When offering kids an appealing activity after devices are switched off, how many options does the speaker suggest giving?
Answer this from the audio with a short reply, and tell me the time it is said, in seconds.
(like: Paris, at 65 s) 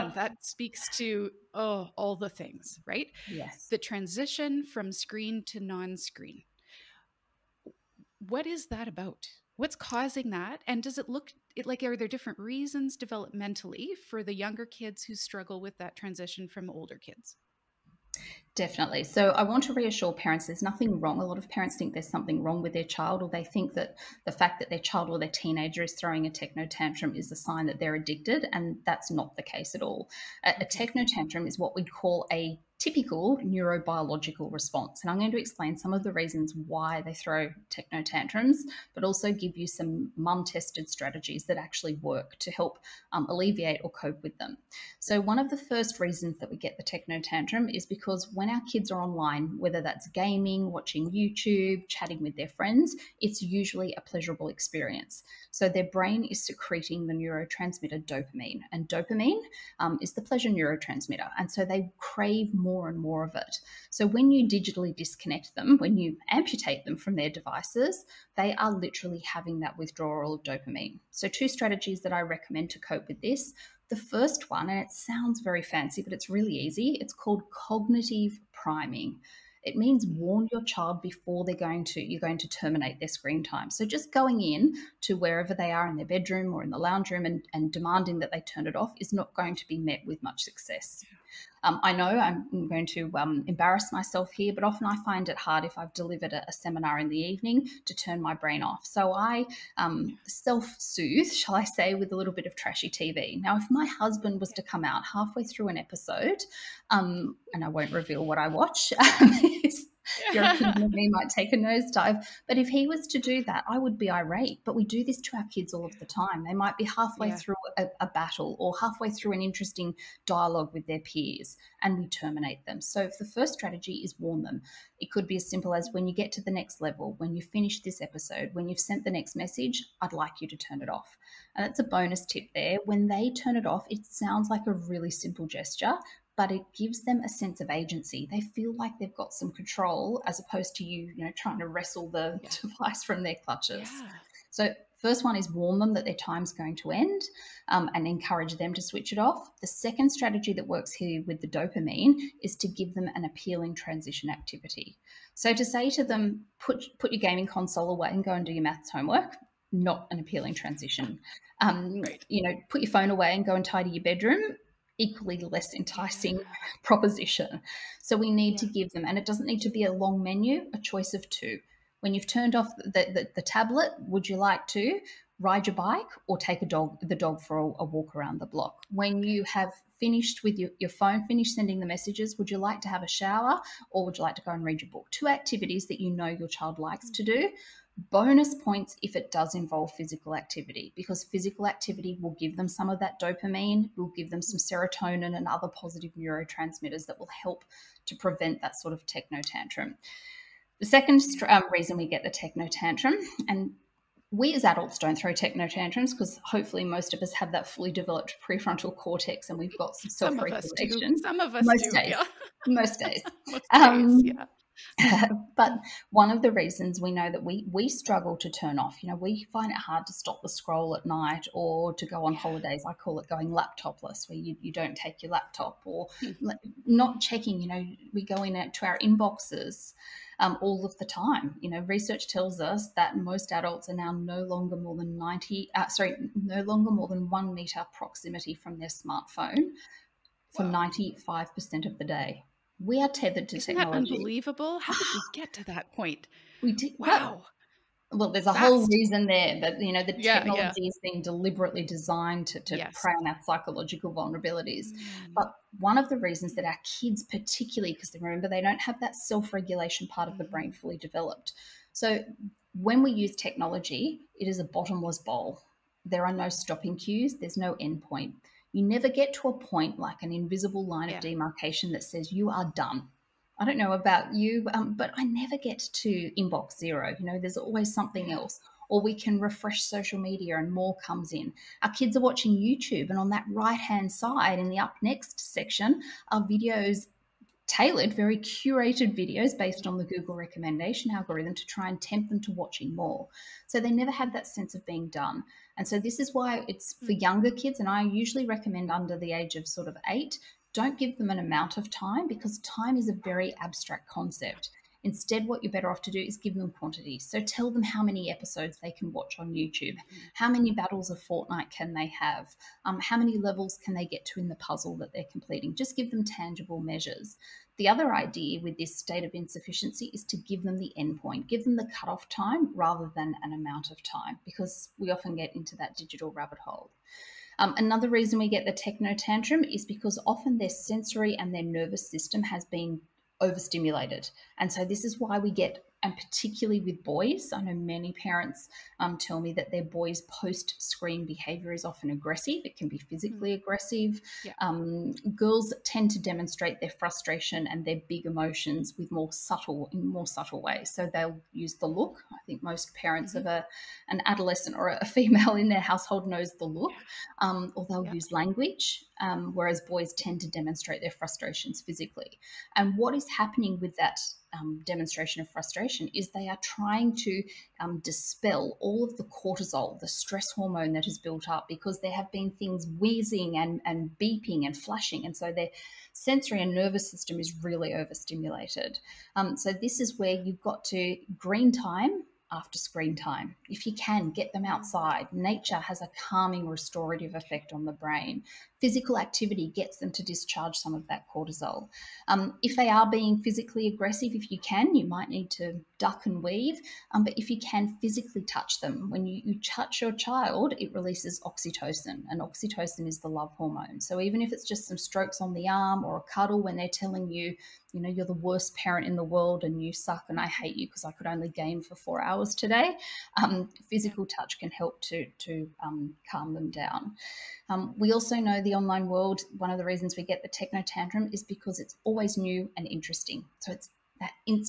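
2, at 170 s.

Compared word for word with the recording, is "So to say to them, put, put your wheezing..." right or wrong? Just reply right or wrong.
wrong.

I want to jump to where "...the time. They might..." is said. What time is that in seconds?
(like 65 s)
115 s.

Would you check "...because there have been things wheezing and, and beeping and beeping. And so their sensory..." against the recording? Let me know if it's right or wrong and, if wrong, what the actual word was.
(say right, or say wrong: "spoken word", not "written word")
wrong: "flashing", not "beeping".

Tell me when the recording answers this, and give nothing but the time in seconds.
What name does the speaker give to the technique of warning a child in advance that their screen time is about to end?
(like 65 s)
77 s.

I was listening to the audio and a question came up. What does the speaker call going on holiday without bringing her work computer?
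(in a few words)
Going laptopless.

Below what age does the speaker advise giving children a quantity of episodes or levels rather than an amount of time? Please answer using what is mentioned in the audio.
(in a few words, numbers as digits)
8.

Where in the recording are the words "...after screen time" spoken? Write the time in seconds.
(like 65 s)
382 s.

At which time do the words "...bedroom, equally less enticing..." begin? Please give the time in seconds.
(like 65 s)
164 s.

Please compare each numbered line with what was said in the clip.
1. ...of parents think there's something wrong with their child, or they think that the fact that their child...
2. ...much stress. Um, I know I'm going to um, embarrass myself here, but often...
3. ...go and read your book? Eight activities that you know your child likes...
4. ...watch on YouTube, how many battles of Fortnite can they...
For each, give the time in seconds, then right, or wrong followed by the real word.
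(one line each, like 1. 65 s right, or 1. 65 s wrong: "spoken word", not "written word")
1. 21 s right
2. 90 s wrong: "success", not "stress"
3. 184 s wrong: "Two", not "Eight"
4. 309 s right.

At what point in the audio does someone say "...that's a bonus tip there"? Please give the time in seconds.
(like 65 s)
131 s.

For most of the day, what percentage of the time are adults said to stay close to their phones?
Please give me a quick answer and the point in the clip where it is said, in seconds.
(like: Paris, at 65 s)
95%, at 240 s.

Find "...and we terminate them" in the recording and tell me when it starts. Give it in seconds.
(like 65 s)
121 s.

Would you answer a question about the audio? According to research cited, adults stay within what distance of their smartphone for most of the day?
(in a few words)
1 meter.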